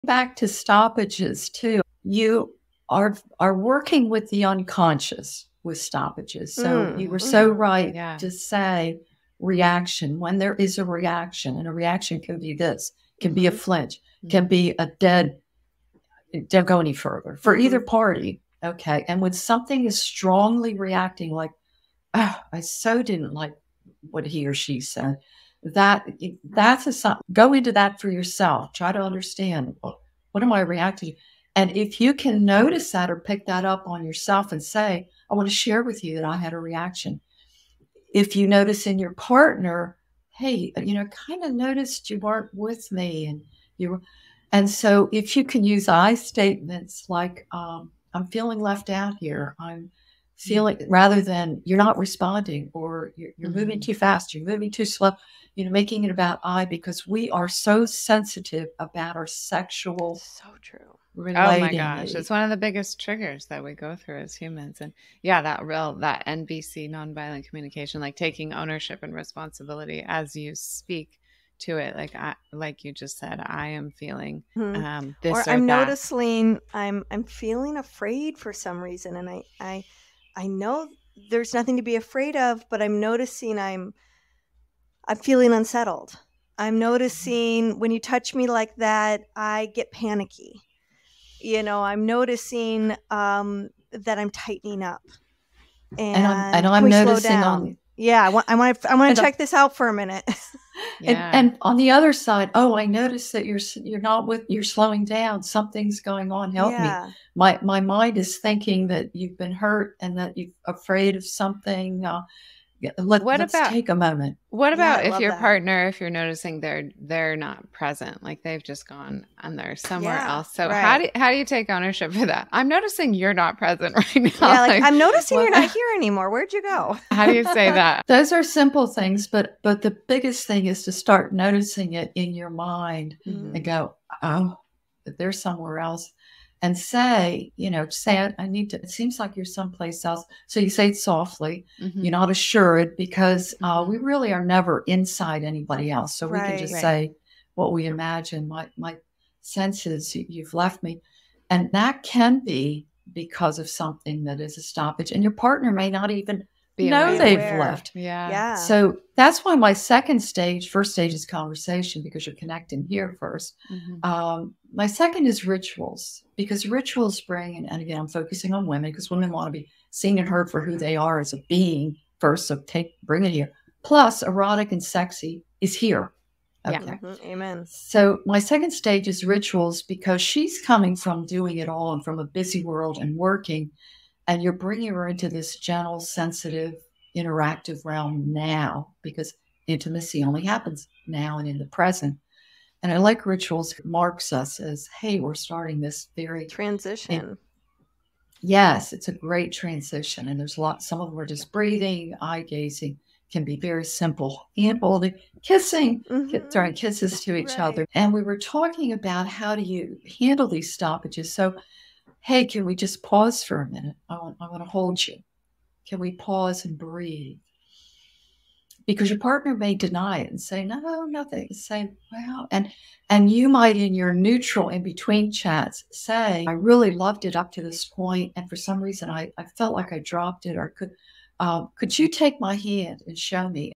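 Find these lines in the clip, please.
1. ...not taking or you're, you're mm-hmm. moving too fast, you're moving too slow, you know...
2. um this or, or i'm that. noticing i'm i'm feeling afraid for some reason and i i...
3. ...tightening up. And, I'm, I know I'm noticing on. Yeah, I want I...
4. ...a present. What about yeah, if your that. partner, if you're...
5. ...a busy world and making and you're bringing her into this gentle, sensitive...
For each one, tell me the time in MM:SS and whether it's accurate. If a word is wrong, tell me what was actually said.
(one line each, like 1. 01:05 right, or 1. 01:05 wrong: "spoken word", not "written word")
1. 00:51 wrong: "responding", not "taking"
2. 01:14 right
3. 01:34 right
4. 01:53 wrong: "moment", not "present"
5. 03:02 wrong: "working", not "making".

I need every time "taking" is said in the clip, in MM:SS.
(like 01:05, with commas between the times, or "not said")
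01:08.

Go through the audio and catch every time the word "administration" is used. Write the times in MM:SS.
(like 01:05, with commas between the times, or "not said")
not said.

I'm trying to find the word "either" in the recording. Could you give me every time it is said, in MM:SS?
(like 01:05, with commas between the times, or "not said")
00:17.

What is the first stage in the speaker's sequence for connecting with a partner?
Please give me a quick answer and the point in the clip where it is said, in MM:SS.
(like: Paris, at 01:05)
Conversation, at 02:41.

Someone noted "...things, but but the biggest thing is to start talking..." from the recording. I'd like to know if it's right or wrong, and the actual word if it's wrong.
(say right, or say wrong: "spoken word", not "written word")
wrong: "noticing", not "talking".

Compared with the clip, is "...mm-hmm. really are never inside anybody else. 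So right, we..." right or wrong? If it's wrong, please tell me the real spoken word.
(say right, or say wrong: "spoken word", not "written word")
right.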